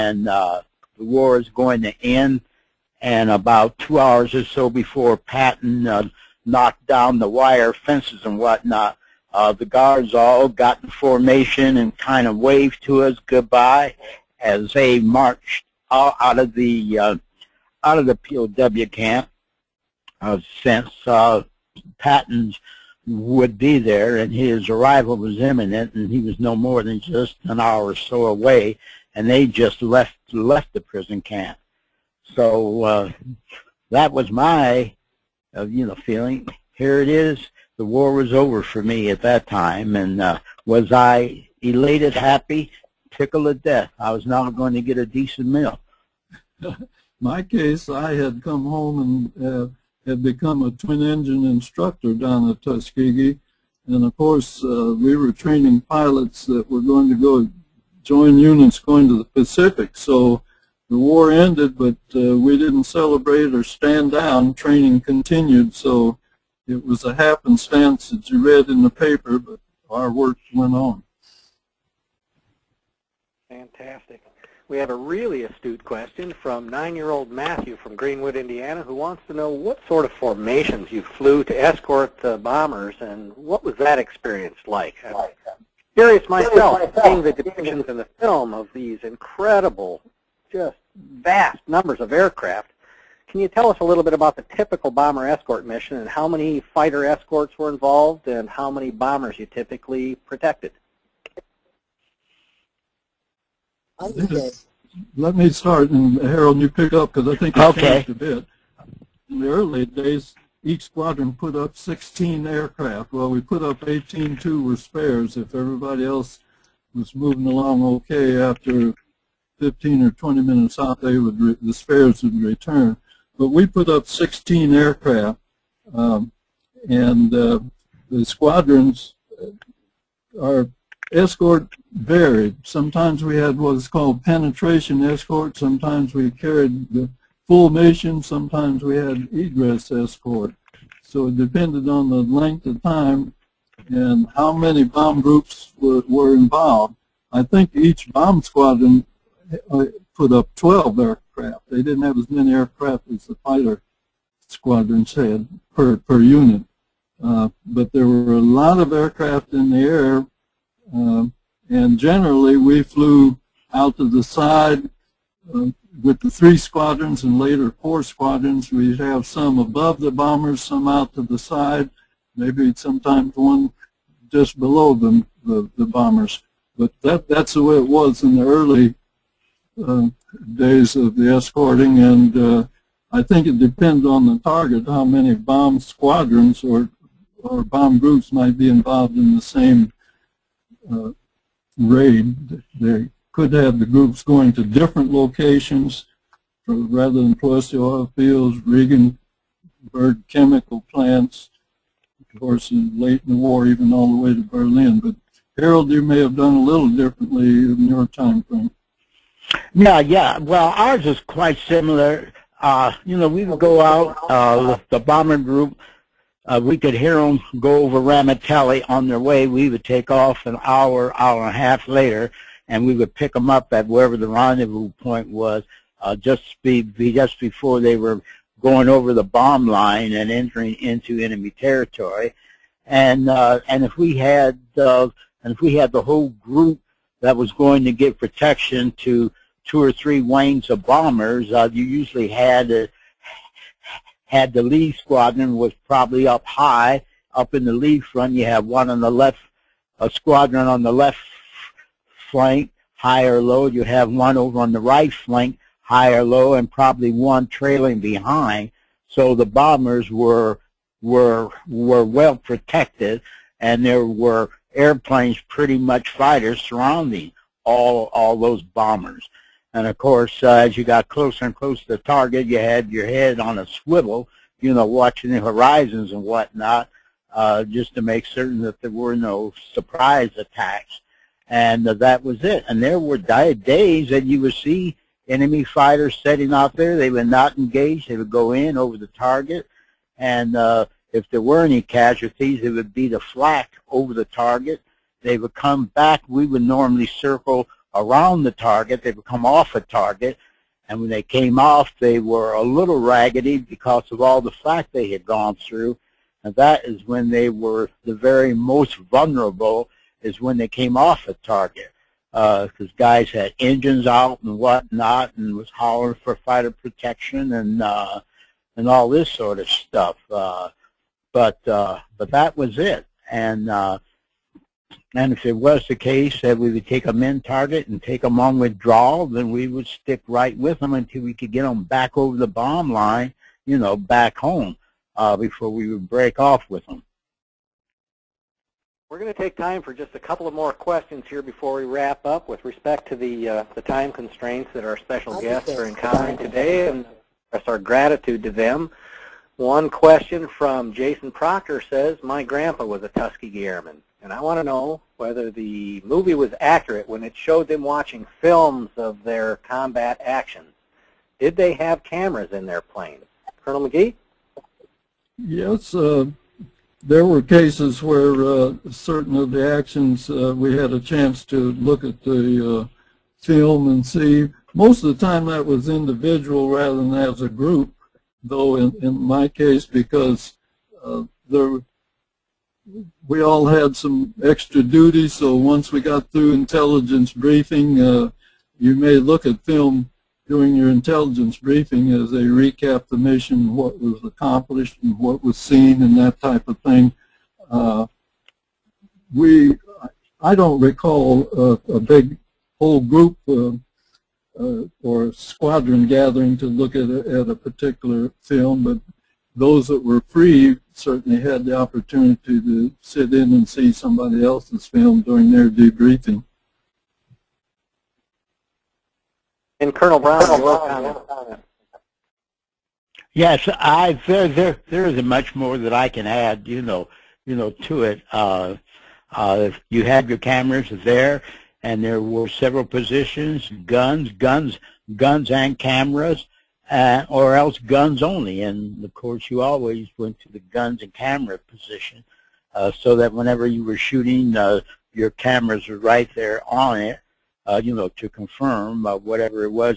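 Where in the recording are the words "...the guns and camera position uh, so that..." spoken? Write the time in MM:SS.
07:20.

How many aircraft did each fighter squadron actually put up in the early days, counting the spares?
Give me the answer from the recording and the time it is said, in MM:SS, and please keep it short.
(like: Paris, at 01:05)
18, at 01:53.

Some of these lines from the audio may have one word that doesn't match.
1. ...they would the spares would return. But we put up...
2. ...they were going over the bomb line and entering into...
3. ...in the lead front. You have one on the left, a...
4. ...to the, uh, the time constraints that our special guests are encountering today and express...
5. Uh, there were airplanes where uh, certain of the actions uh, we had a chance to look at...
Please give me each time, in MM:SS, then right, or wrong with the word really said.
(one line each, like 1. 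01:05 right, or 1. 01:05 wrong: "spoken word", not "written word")
1. 02:01 right
2. 03:47 right
3. 04:07 right
4. 05:43 right
5. 06:05 wrong: "cases", not "airplanes".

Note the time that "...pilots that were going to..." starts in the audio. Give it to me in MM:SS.
00:55.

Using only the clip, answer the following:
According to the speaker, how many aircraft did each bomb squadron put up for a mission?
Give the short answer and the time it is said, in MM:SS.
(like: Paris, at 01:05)
12, at 02:30.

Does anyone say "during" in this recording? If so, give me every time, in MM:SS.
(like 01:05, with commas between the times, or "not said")
06:30, 06:55.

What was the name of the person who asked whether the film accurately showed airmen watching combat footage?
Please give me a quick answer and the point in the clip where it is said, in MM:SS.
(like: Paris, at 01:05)
Jason Proctor, at 05:50.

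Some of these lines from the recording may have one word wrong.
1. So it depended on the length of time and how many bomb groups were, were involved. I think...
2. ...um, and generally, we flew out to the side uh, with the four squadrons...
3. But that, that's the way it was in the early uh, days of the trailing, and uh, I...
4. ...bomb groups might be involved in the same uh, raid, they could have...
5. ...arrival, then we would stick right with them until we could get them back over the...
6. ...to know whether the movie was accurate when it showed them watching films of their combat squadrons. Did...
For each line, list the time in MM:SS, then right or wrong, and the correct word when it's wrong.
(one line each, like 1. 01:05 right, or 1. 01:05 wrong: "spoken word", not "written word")
1. 02:21 right
2. 02:40 wrong: "three", not "four"
3. 02:56 wrong: "escorting", not "trailing"
4. 03:07 right
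5. 05:28 wrong: "withdrawal", not "arrival"
6. 05:54 wrong: "actions", not "squadrons".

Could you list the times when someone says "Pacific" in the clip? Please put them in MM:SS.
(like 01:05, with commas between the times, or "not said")
00:59.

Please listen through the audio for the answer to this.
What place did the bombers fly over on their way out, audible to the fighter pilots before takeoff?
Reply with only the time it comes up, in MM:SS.
03:37.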